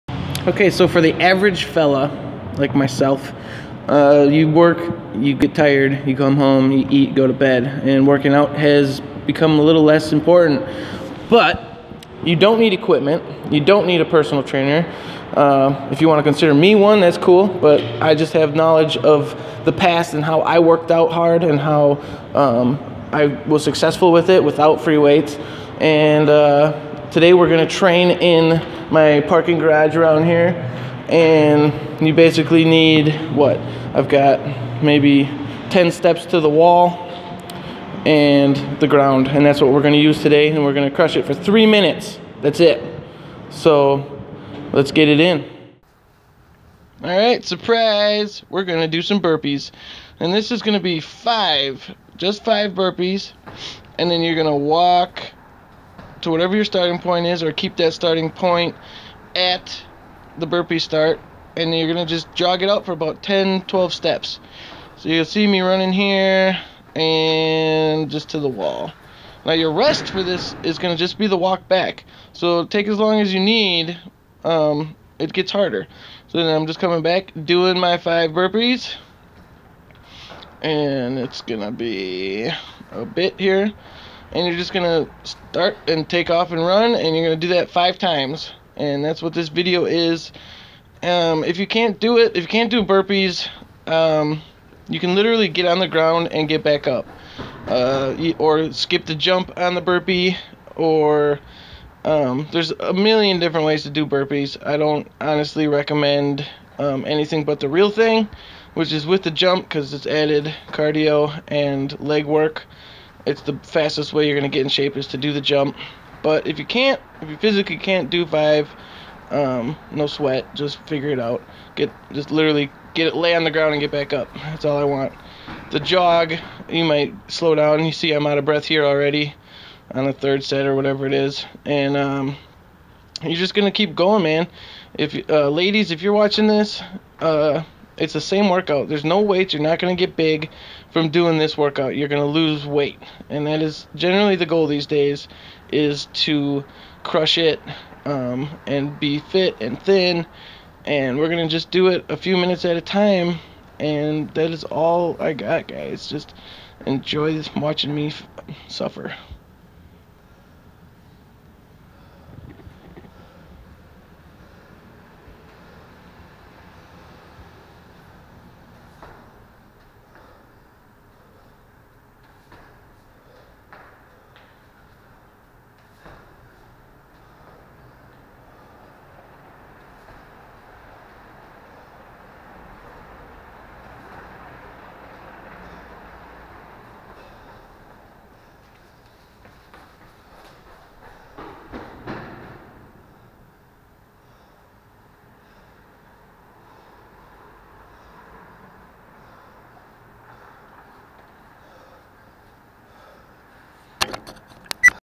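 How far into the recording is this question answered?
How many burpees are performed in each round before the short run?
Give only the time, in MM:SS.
00:51.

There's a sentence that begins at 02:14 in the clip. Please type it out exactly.
If uh, ladies, if you're watching this, uh, it's the same workout.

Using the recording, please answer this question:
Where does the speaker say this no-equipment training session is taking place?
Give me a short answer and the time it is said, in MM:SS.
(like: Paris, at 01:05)
parking garage, at 00:29.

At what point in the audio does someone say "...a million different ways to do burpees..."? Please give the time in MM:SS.
01:42.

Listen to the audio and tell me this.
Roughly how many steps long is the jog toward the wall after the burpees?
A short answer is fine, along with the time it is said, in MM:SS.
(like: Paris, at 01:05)
10 12 steps, at 01:03.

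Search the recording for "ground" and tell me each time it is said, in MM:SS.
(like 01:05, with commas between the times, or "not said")
00:38, 01:35, 02:03.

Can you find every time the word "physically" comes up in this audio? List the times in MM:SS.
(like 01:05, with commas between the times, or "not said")
01:57.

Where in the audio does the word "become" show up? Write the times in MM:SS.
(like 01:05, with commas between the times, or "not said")
00:09.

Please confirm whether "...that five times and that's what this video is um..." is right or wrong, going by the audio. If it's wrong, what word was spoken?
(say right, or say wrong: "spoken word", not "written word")
right.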